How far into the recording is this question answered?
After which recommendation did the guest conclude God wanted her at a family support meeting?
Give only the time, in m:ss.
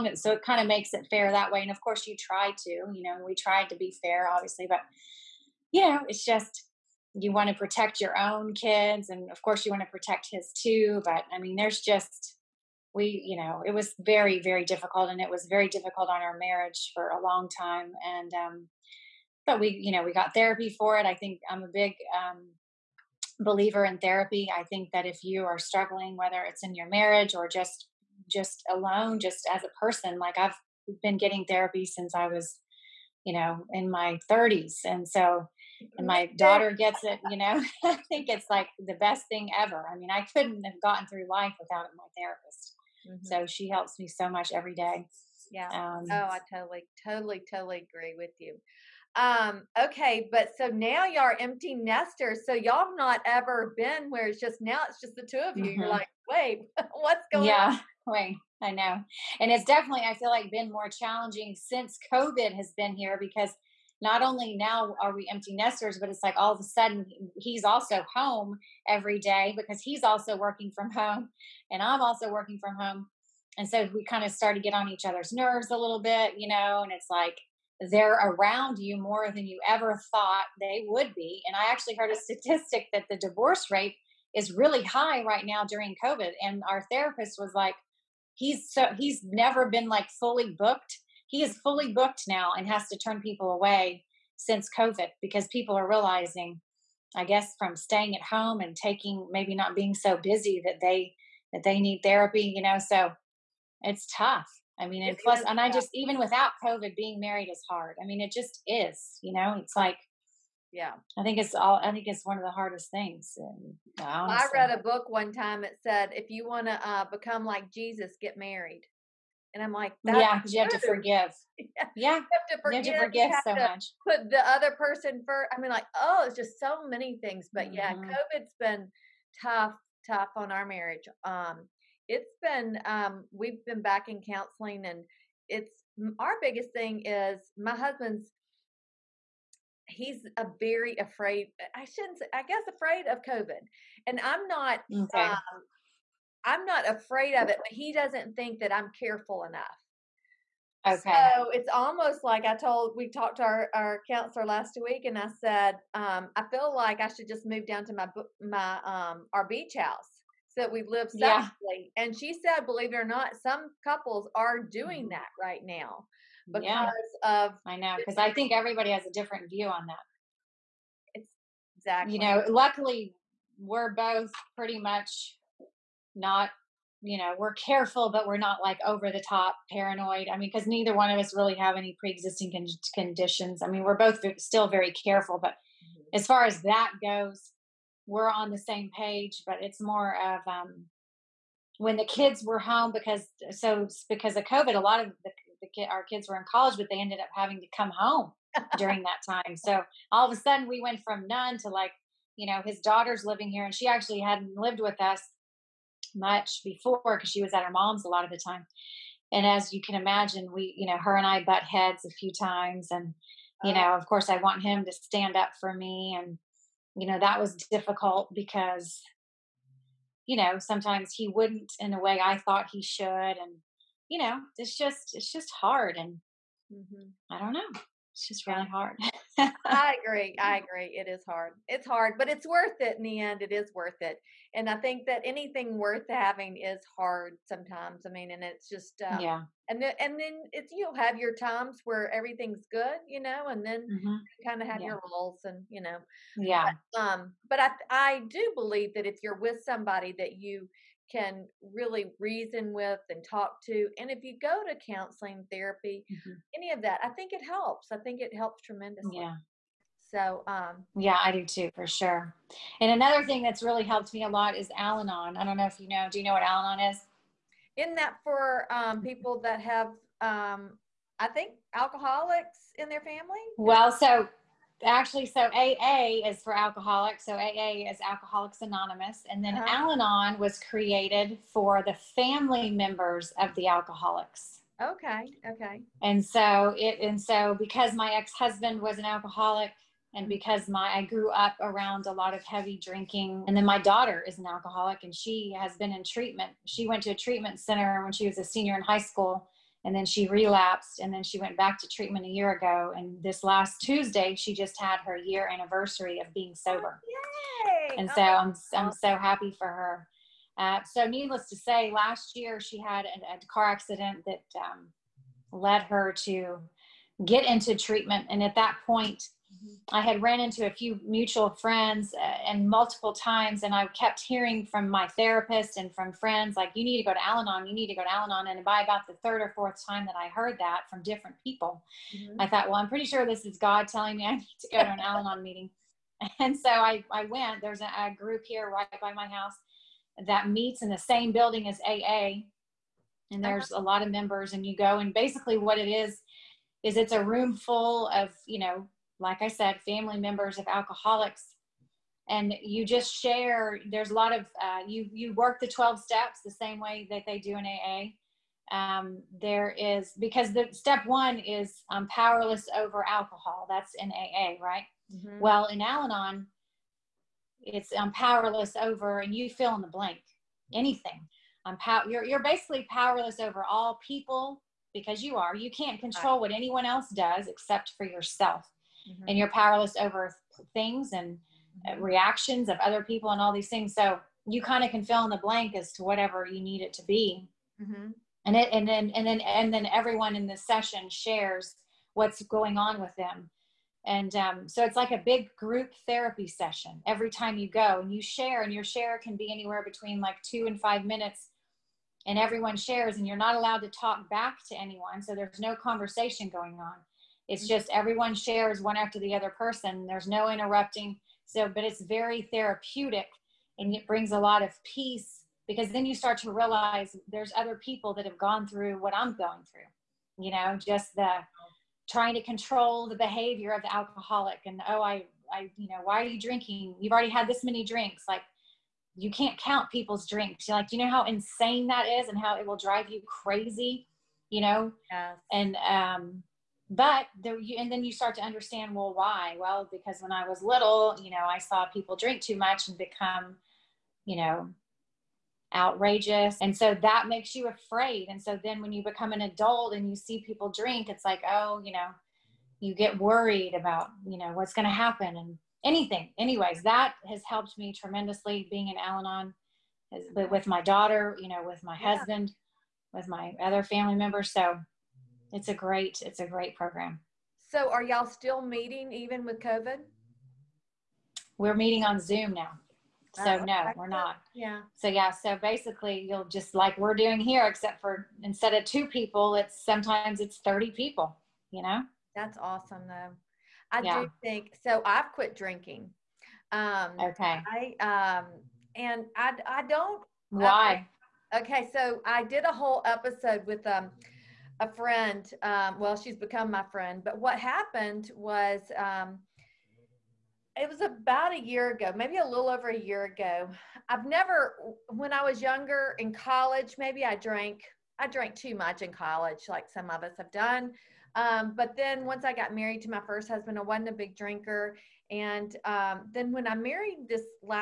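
5:29.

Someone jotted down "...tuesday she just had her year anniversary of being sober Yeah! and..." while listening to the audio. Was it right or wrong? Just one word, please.
wrong.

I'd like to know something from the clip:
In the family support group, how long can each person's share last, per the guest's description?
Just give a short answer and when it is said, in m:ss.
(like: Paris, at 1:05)
2 to 5 minutes, at 6:40.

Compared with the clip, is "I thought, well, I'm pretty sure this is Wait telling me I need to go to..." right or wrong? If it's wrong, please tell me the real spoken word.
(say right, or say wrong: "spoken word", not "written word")
wrong: "God", not "Wait".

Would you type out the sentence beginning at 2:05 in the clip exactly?
I mean, like, oh, it's just so many things.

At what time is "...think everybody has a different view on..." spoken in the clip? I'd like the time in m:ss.
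2:48.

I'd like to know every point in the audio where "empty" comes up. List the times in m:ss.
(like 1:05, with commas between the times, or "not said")
0:51, 1:05.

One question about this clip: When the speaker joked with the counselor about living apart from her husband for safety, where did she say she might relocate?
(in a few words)
beach house.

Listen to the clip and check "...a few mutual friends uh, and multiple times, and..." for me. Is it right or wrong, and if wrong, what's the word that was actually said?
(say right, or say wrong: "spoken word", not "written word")
right.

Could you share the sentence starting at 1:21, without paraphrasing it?
And I actually heard a statistic that the divorce rate is really high right now during COVID.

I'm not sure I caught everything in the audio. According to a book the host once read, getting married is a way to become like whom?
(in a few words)
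Jesus.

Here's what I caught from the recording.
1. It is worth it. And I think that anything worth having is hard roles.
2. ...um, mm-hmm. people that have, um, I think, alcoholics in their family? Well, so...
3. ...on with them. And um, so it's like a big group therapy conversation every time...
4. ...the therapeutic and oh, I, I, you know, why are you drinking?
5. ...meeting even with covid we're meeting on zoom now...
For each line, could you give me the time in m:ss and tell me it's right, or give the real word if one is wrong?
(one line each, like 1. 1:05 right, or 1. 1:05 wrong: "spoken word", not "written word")
1. 3:53 wrong: "sometimes", not "roles"
2. 4:28 right
3. 6:32 wrong: "session", not "conversation"
4. 7:03 wrong: "alcoholic", not "therapeutic"
5. 7:48 right.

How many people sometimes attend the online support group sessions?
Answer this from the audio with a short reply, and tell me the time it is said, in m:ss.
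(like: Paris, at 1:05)
30, at 8:00.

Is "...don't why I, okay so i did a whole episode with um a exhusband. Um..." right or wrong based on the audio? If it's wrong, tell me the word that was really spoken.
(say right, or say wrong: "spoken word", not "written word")
wrong: "friend", not "exhusband".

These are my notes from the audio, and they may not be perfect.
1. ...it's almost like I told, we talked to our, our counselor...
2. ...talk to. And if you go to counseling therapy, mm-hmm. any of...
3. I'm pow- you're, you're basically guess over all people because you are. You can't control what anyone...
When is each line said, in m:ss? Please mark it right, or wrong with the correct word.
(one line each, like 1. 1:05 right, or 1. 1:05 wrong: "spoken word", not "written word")
1. 2:31 right
2. 4:13 right
3. 6:11 wrong: "powerless", not "guess".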